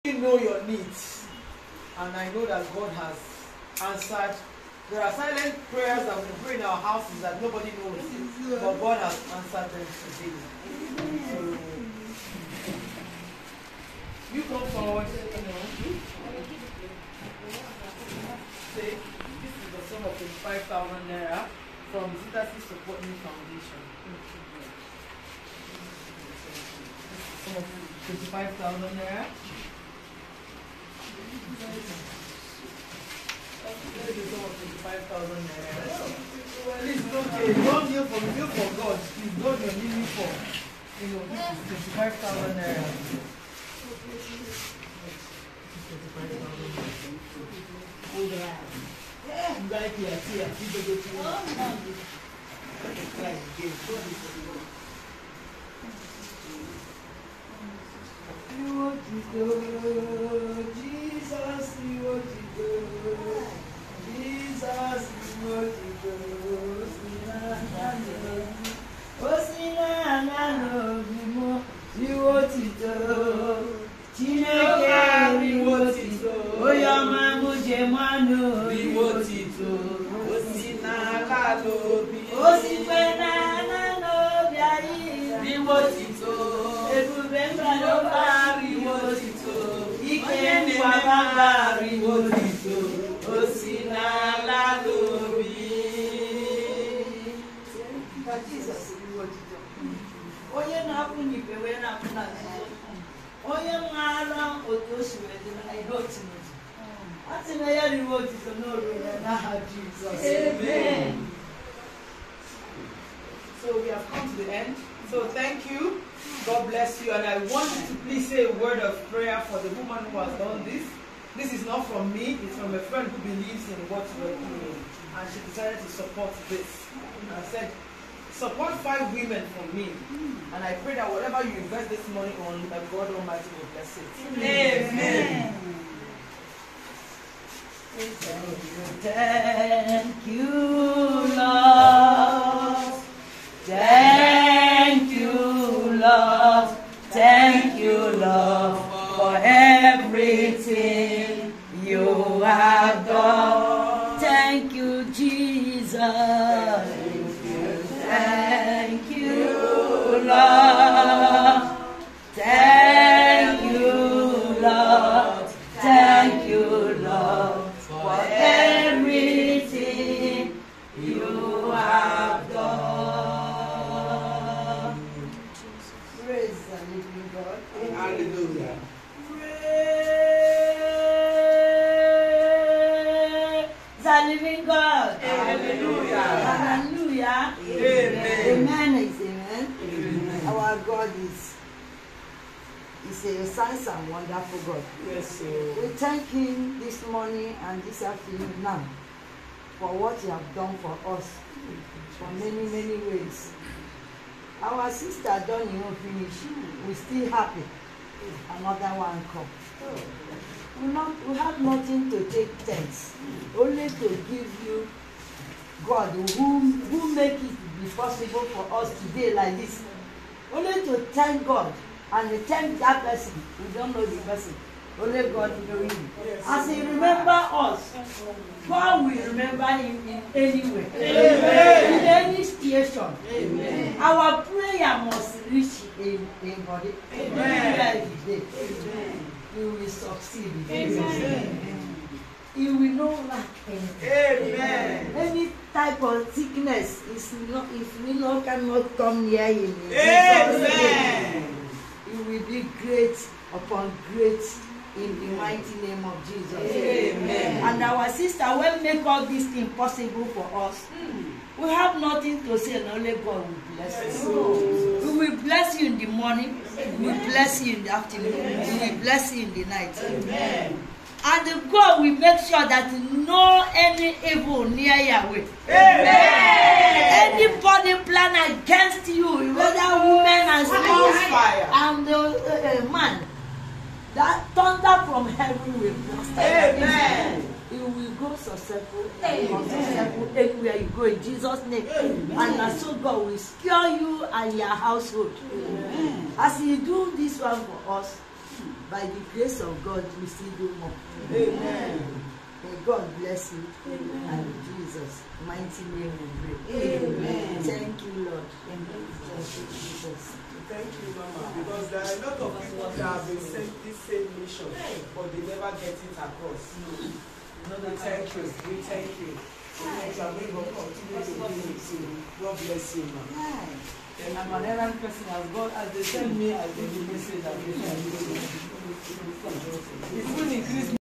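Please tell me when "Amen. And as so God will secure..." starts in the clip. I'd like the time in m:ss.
4:51.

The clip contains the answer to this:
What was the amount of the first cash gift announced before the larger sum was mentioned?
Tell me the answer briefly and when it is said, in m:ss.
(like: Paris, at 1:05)
5,000 naira, at 0:20.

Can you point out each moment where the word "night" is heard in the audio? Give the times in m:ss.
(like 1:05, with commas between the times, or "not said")
4:29.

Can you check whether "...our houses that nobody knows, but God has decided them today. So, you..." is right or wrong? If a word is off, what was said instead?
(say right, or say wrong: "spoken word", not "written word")
wrong: "answered", not "decided".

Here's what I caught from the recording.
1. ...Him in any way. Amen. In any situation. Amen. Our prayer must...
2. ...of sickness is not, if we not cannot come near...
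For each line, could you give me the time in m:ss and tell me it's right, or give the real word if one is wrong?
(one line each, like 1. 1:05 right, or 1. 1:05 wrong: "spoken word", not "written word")
1. 3:49 right
2. 4:06 right.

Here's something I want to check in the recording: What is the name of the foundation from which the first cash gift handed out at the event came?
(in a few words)
Zitasi Support Me Foundation.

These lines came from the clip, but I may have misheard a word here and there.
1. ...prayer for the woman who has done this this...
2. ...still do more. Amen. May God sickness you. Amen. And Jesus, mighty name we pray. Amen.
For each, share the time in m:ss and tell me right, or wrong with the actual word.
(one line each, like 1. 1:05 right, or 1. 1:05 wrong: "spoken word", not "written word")
1. 1:59 right
2. 5:00 wrong: "bless", not "sickness".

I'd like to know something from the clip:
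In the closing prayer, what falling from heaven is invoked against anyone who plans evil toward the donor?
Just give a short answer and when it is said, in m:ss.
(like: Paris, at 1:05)
Thunder, at 4:44.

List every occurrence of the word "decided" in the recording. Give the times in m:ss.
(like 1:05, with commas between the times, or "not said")
2:05.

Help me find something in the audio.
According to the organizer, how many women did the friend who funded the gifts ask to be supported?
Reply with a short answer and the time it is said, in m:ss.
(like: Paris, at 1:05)
5, at 2:08.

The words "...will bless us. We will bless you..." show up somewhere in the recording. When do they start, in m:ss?
4:23.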